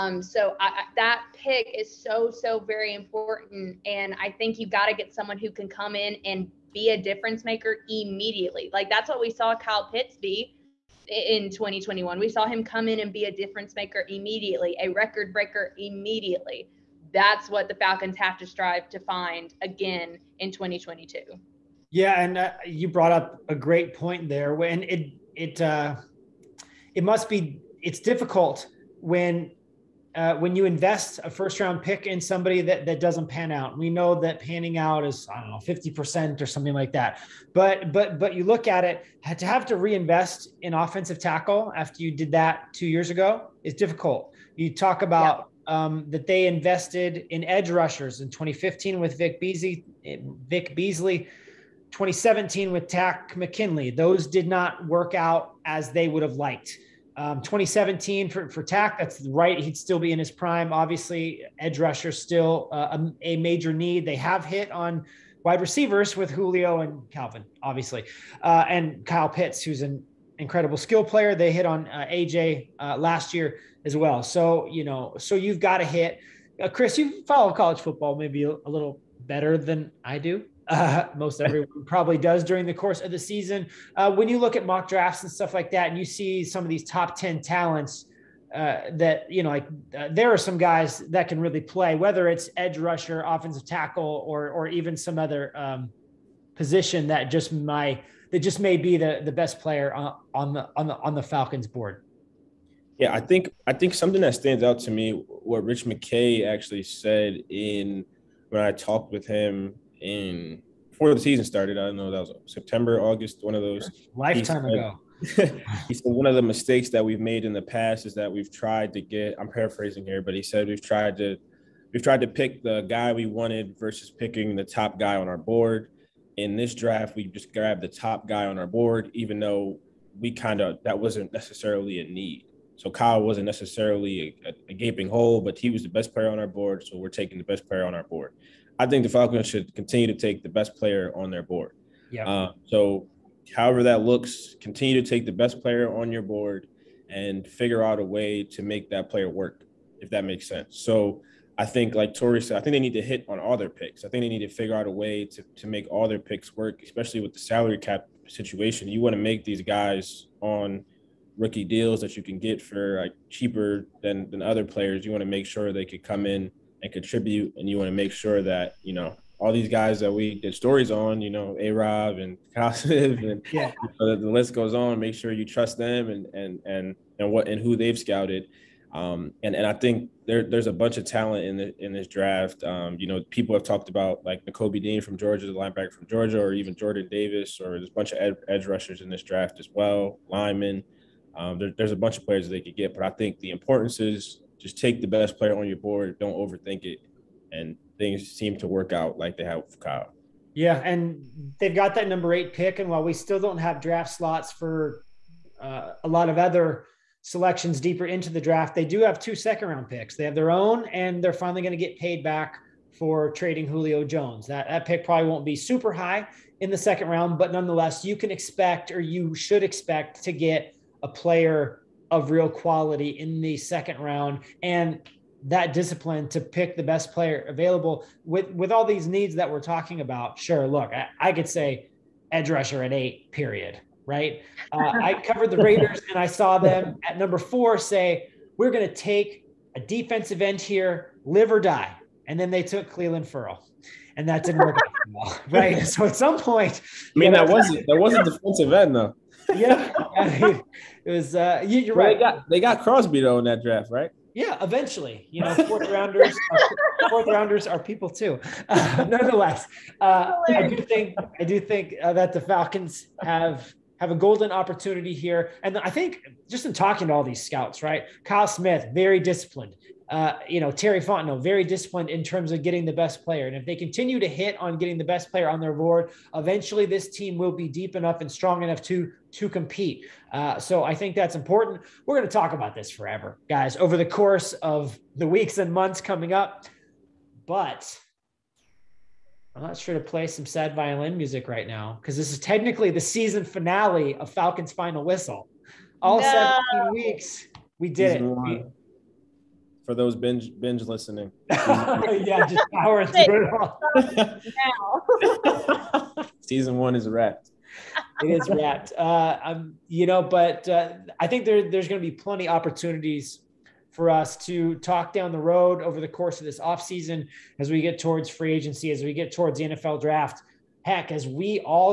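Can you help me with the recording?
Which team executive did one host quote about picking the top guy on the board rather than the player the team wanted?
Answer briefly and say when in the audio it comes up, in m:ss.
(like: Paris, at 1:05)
Rich McKay, at 1:45.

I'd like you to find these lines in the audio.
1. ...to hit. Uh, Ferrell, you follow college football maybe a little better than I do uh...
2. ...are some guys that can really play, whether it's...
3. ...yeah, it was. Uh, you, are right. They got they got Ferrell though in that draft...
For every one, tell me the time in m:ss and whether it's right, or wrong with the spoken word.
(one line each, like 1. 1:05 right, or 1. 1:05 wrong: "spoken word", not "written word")
1. 1:15 wrong: "Kris", not "Ferrell"
2. 1:30 right
3. 4:09 wrong: "Crosby", not "Ferrell".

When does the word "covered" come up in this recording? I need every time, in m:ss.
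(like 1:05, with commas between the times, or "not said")
3:55.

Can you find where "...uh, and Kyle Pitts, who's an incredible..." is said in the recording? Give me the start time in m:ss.
1:08.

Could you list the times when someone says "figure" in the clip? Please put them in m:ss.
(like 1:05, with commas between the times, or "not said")
2:27, 2:34.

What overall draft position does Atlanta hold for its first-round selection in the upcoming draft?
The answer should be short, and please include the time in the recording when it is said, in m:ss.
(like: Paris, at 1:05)
8, at 3:22.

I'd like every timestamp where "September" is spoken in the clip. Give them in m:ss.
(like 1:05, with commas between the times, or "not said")
1:52.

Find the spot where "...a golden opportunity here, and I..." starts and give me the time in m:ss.
4:24.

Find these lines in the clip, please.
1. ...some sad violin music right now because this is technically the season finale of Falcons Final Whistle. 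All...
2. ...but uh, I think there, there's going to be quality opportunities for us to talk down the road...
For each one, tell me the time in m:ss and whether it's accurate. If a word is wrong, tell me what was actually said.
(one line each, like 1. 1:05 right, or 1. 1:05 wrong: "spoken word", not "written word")
1. 4:50 right
2. 5:10 wrong: "plenty", not "quality".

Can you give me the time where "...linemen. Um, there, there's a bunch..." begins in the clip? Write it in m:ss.
3:10.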